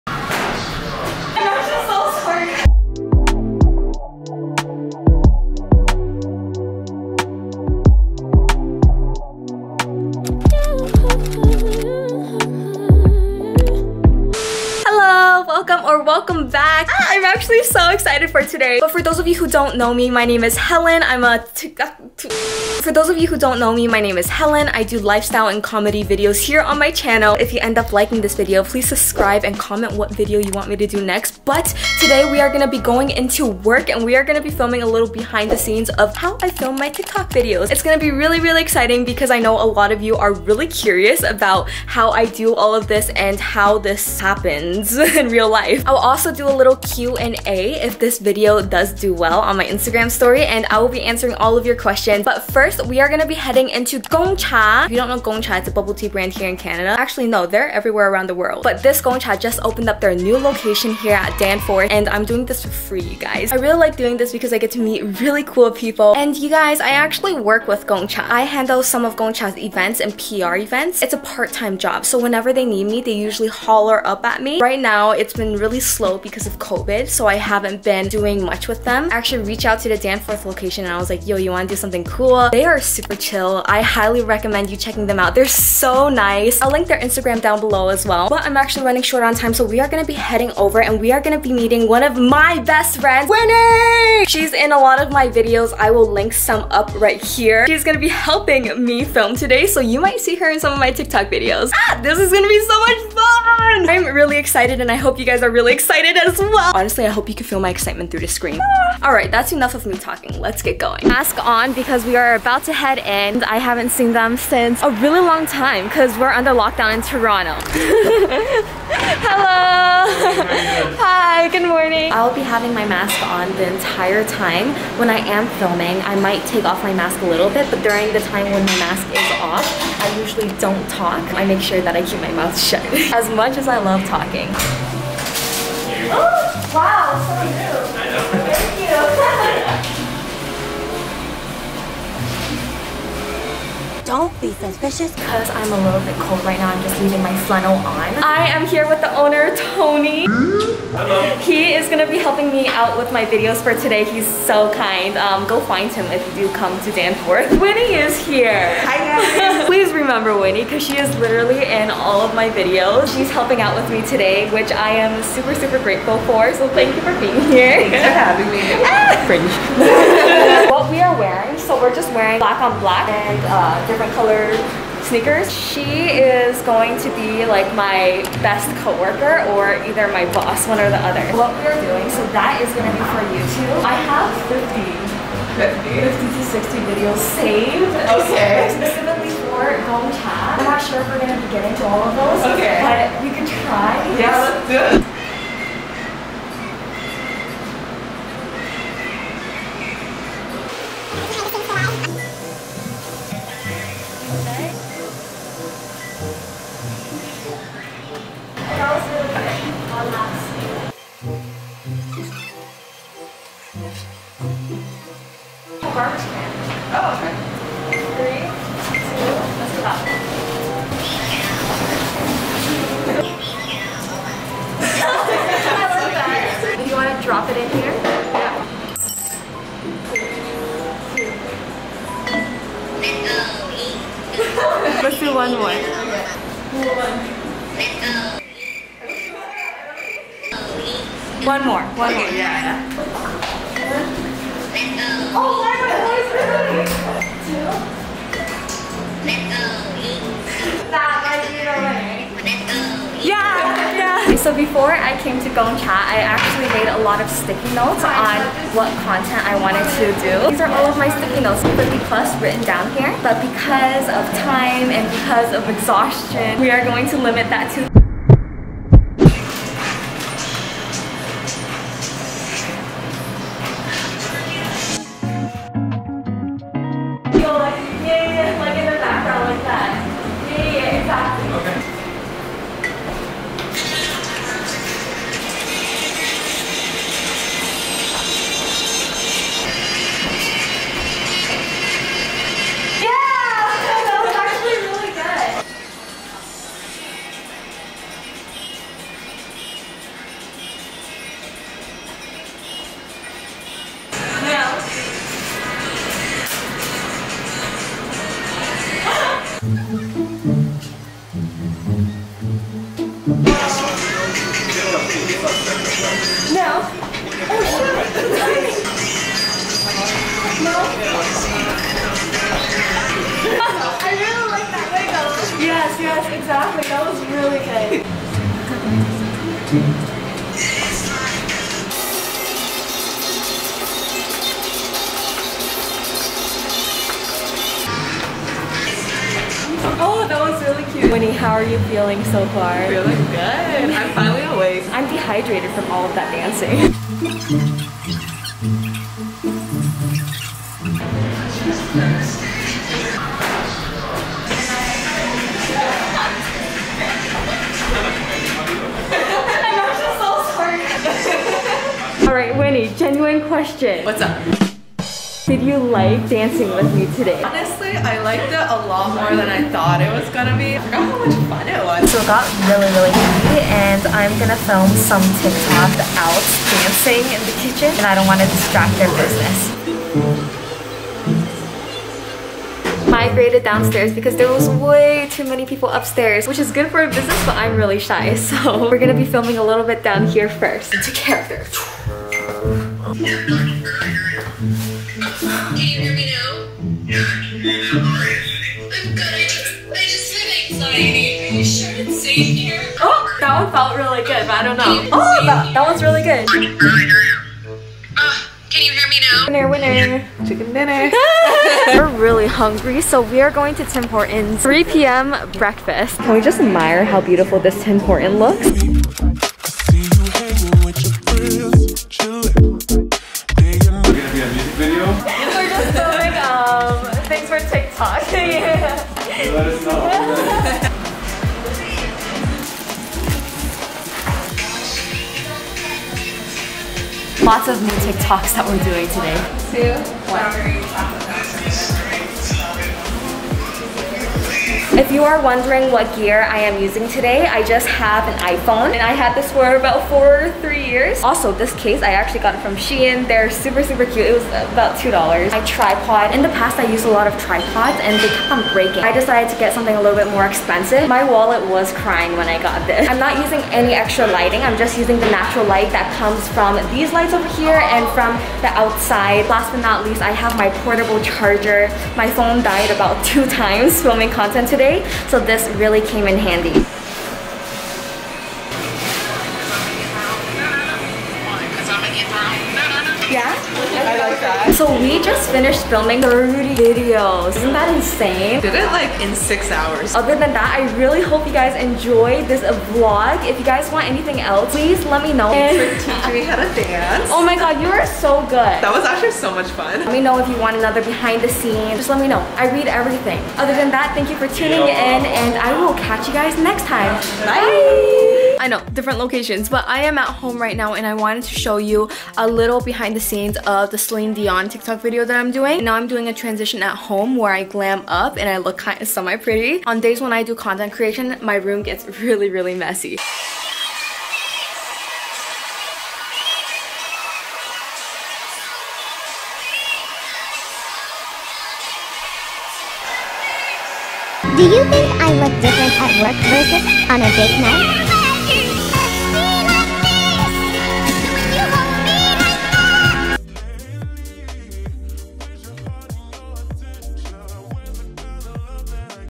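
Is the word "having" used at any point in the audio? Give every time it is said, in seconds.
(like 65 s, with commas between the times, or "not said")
122 s, 168 s.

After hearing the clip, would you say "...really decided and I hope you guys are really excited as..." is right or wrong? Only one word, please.
wrong.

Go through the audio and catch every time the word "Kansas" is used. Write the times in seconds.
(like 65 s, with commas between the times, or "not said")
not said.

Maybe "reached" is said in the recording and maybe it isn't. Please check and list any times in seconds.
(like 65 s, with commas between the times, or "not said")
79 s.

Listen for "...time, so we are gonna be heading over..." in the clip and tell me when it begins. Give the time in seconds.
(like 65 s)
89 s.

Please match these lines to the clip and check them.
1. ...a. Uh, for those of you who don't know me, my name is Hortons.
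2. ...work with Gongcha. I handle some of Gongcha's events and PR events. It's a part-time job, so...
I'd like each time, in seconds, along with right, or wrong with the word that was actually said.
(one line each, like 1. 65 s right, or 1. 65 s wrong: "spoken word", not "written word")
1. 21 s wrong: "Helen", not "Hortons"
2. 67 s right.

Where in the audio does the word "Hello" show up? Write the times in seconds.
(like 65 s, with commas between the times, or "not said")
119 s, 150 s.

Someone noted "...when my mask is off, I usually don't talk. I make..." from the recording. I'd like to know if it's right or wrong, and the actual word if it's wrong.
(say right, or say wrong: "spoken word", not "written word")
right.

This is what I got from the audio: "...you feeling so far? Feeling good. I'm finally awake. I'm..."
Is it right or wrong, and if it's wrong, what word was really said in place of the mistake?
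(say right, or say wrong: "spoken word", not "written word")
right.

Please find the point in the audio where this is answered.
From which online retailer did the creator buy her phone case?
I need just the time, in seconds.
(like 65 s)
452 s.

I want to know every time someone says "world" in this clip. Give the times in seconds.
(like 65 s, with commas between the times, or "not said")
58 s.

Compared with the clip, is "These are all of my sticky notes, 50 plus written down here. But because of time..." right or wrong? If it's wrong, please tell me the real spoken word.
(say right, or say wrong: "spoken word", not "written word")
right.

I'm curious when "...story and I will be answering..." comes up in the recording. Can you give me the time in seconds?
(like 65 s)
50 s.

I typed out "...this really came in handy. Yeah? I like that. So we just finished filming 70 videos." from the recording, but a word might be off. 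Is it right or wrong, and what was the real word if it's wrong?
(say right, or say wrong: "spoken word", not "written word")
wrong: "30", not "70".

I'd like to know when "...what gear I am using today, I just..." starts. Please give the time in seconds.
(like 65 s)
445 s.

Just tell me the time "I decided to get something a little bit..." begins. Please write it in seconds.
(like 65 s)
459 s.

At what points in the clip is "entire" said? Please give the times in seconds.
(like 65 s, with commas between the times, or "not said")
123 s.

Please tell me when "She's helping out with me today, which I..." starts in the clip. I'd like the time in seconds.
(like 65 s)
163 s.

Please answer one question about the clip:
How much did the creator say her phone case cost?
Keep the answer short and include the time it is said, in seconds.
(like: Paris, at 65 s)
$2, at 454 s.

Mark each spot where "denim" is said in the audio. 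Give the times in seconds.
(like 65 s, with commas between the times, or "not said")
not said.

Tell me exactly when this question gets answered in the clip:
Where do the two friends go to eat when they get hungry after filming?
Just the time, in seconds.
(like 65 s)
413 s.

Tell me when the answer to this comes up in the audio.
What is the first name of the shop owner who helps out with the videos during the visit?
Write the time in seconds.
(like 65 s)
149 s.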